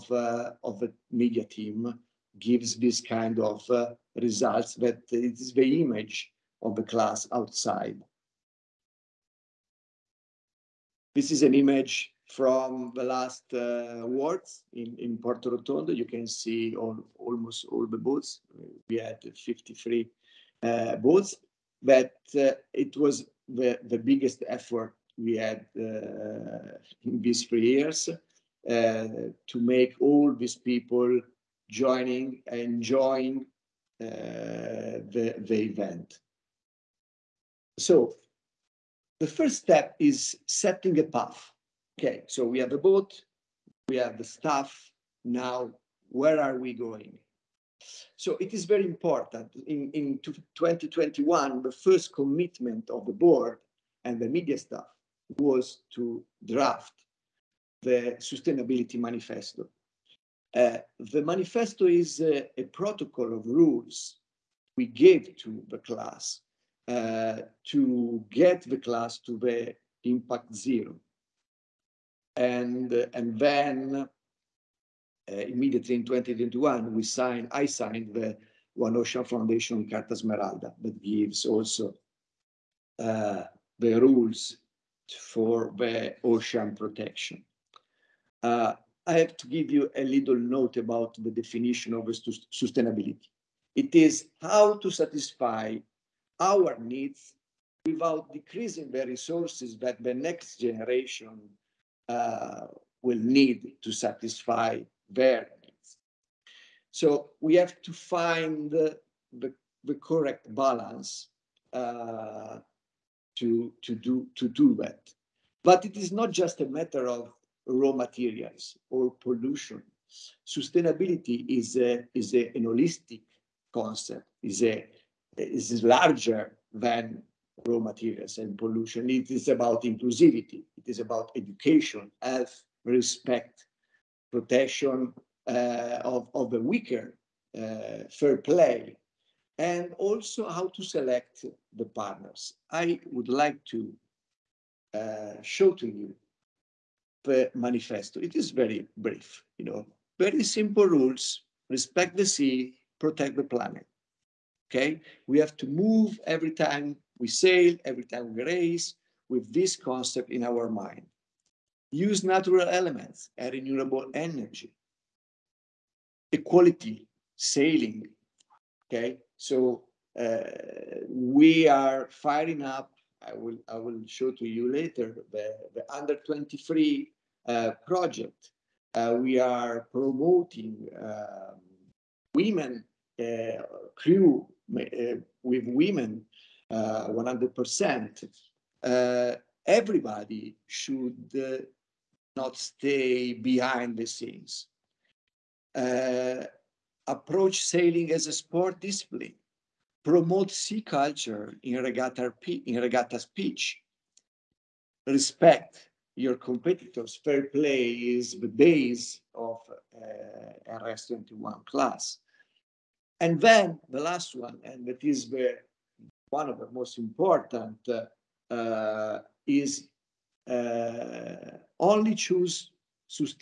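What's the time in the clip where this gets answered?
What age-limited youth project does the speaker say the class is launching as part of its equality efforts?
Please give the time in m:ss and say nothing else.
2:55.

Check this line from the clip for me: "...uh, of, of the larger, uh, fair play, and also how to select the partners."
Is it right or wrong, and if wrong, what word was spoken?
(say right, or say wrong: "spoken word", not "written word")
wrong: "weaker", not "larger".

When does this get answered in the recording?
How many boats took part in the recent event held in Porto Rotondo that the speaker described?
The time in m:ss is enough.
0:19.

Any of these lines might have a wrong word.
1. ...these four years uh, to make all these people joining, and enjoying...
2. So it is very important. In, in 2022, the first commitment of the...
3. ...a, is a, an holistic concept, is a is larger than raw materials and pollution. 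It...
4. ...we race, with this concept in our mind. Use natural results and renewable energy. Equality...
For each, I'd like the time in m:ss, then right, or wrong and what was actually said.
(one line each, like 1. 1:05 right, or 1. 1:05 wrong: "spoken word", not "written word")
1. 0:27 wrong: "three", not "four"
2. 0:48 wrong: "2021", not "2022"
3. 2:01 right
4. 2:38 wrong: "elements", not "results".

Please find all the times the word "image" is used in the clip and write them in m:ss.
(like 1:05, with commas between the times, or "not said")
0:05, 0:11.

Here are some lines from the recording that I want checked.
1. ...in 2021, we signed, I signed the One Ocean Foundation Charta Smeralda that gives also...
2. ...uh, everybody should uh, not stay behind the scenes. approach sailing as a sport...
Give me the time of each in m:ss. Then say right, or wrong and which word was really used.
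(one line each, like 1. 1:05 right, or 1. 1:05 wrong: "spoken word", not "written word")
1. 1:15 right
2. 3:08 right.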